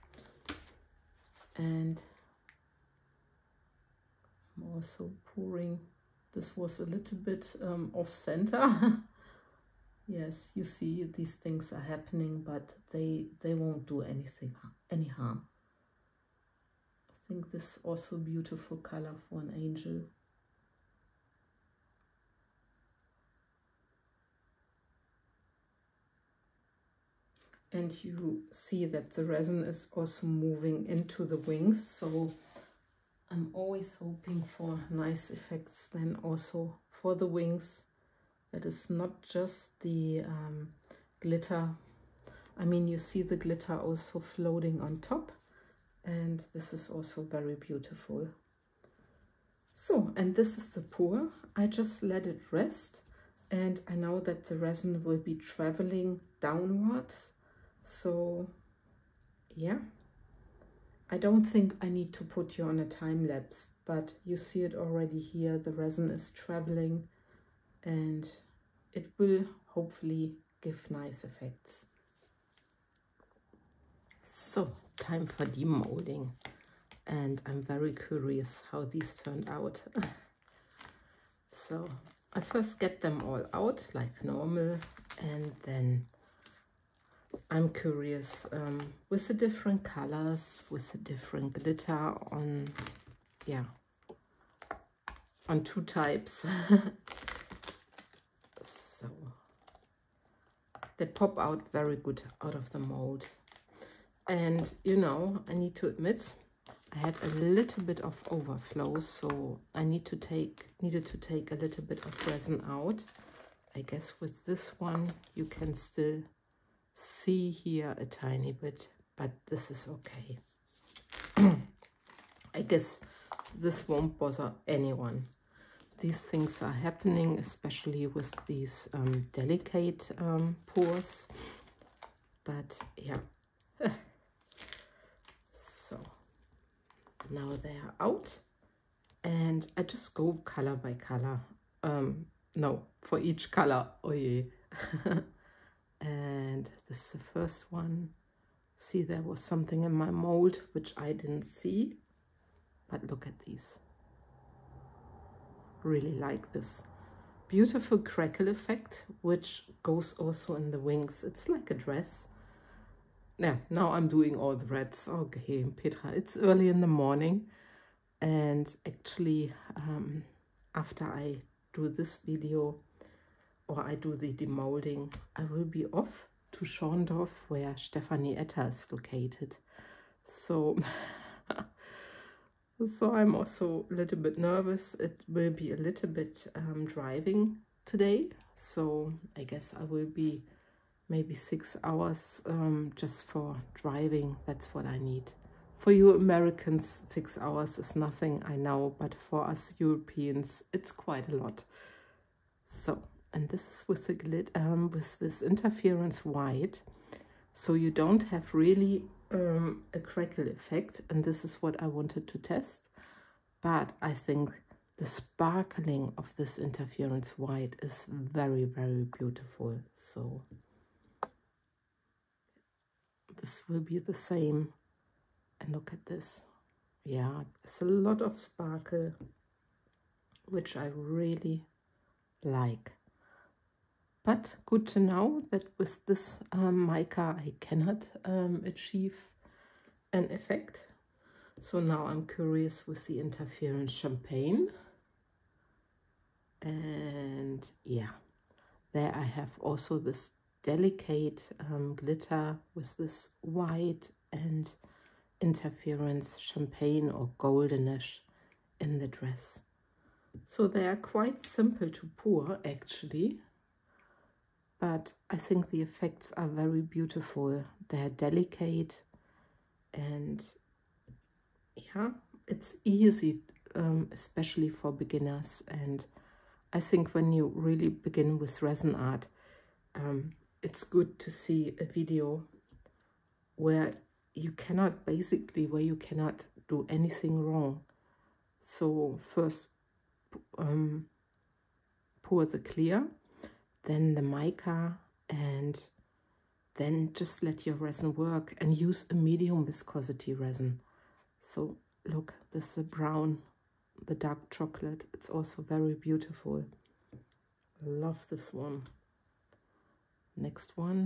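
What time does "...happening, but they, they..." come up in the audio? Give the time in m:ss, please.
0:11.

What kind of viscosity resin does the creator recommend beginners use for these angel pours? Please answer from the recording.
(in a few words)
medium viscosity.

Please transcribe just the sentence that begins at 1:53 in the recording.
I guess with this one you can still see here a tiny bit, but this is okay.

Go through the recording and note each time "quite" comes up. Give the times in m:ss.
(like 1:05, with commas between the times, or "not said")
3:20, 4:20.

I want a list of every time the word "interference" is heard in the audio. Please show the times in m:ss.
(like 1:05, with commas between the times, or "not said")
3:25, 3:36, 4:03, 4:15.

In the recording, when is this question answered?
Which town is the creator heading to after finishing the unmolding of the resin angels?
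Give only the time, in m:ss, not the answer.
2:56.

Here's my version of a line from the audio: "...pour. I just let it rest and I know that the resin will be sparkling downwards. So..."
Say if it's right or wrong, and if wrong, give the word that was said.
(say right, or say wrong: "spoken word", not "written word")
wrong: "traveling", not "sparkling".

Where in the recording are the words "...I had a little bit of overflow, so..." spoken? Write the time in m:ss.
1:46.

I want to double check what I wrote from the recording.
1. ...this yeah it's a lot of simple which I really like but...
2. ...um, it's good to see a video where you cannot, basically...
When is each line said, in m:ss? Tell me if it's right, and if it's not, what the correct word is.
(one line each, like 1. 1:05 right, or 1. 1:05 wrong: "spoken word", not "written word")
1. 3:46 wrong: "sparkle", not "simple"
2. 4:39 right.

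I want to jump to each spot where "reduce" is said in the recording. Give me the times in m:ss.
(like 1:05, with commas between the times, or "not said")
not said.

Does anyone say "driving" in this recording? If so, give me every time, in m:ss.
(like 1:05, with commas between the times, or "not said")
3:06, 3:13.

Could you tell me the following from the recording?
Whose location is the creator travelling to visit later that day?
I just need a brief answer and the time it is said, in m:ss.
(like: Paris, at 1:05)
Stephanie Etter, at 2:57.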